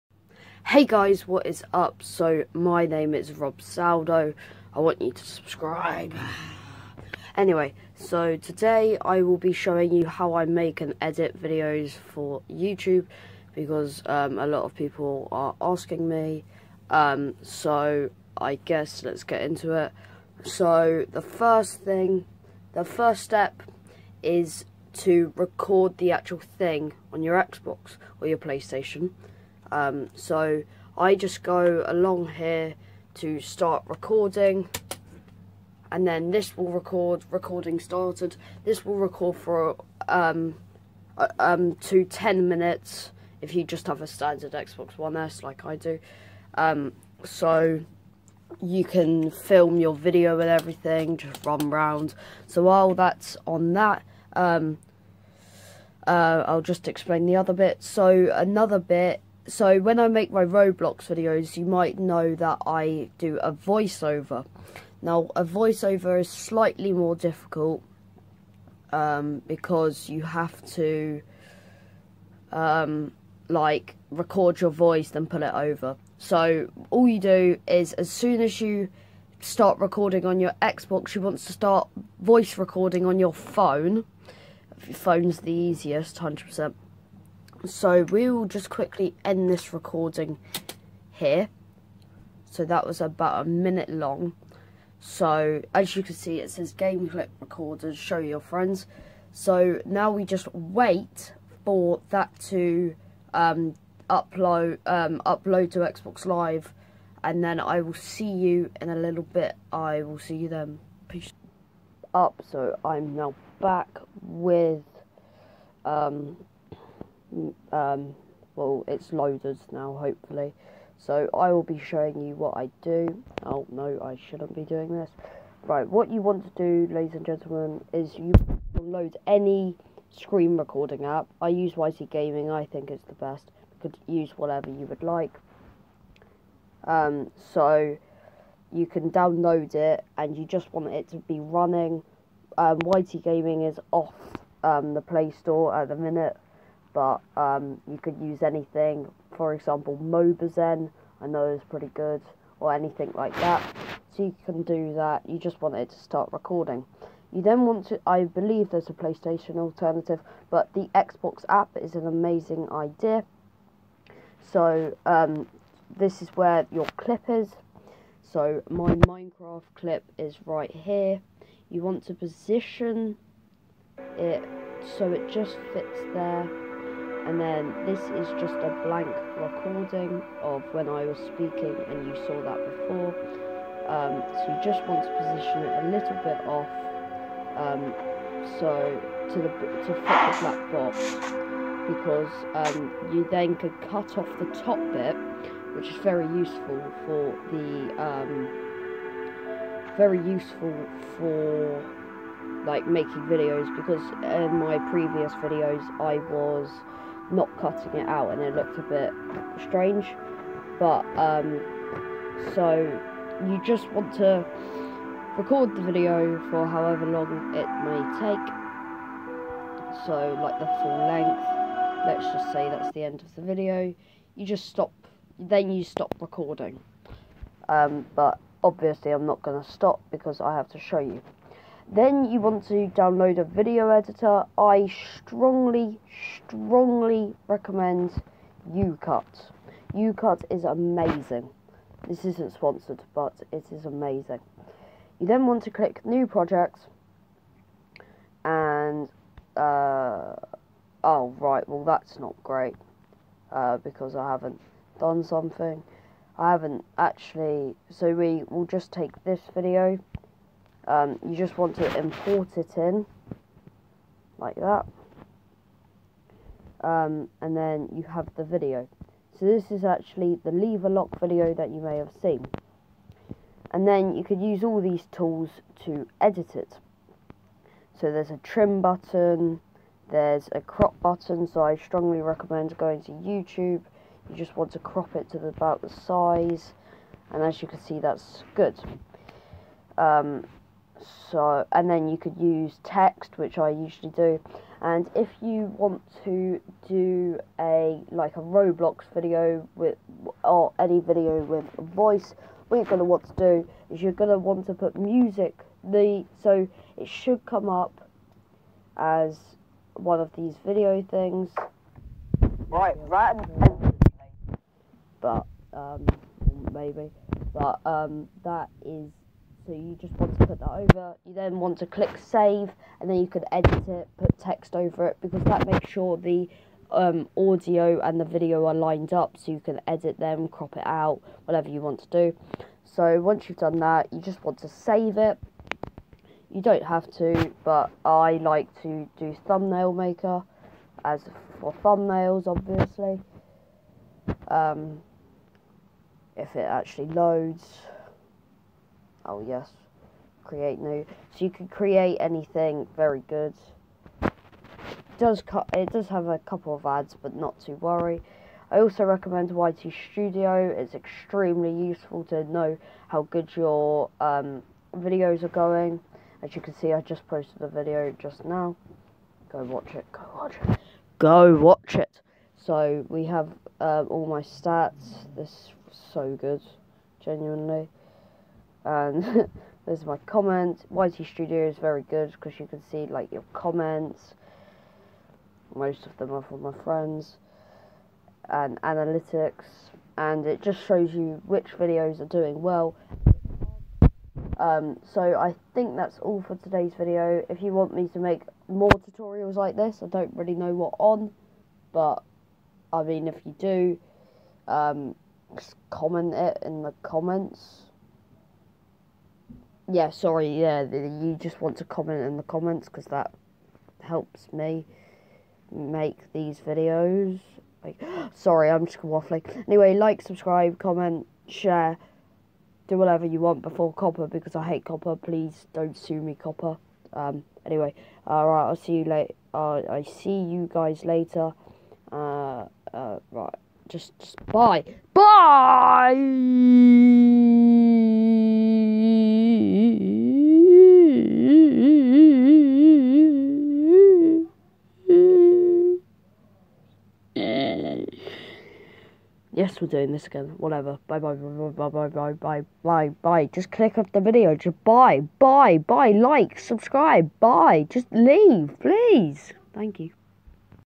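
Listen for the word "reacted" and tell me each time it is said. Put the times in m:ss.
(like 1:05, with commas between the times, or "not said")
not said.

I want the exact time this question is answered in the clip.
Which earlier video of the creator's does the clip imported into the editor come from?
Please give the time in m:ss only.
4:30.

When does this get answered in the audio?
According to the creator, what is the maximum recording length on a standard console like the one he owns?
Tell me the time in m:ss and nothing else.
0:42.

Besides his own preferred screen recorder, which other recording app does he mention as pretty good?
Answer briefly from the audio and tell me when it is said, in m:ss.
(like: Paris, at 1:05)
Mobizen, at 2:30.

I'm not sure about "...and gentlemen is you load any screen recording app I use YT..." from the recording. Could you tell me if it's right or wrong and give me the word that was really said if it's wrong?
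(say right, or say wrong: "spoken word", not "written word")
right.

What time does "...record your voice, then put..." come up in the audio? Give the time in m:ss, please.
1:14.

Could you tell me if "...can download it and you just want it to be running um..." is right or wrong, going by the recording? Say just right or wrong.
right.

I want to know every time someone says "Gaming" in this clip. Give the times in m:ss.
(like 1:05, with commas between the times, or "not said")
2:12, 2:23.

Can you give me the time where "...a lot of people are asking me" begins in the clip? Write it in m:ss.
0:14.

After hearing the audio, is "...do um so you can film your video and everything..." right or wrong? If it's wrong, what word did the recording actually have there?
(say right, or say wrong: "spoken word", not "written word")
right.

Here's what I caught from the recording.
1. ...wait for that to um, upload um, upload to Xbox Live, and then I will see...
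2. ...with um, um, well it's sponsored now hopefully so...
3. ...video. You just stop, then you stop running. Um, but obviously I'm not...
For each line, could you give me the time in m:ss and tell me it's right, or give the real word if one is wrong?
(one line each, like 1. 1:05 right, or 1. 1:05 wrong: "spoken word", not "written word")
1. 1:40 right
2. 1:54 wrong: "loaded", not "sponsored"
3. 3:43 wrong: "recording", not "running".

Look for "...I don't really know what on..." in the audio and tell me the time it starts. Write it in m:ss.
6:40.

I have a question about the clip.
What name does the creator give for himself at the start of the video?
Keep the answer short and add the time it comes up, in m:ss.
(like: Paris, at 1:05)
Robzaldo, at 0:03.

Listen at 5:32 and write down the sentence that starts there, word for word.
So once you've done that, you just want to save it.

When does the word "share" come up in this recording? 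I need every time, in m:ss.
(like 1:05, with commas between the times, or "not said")
7:01.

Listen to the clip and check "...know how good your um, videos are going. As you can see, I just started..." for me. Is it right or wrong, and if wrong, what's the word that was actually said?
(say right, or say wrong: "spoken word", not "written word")
wrong: "posted", not "started".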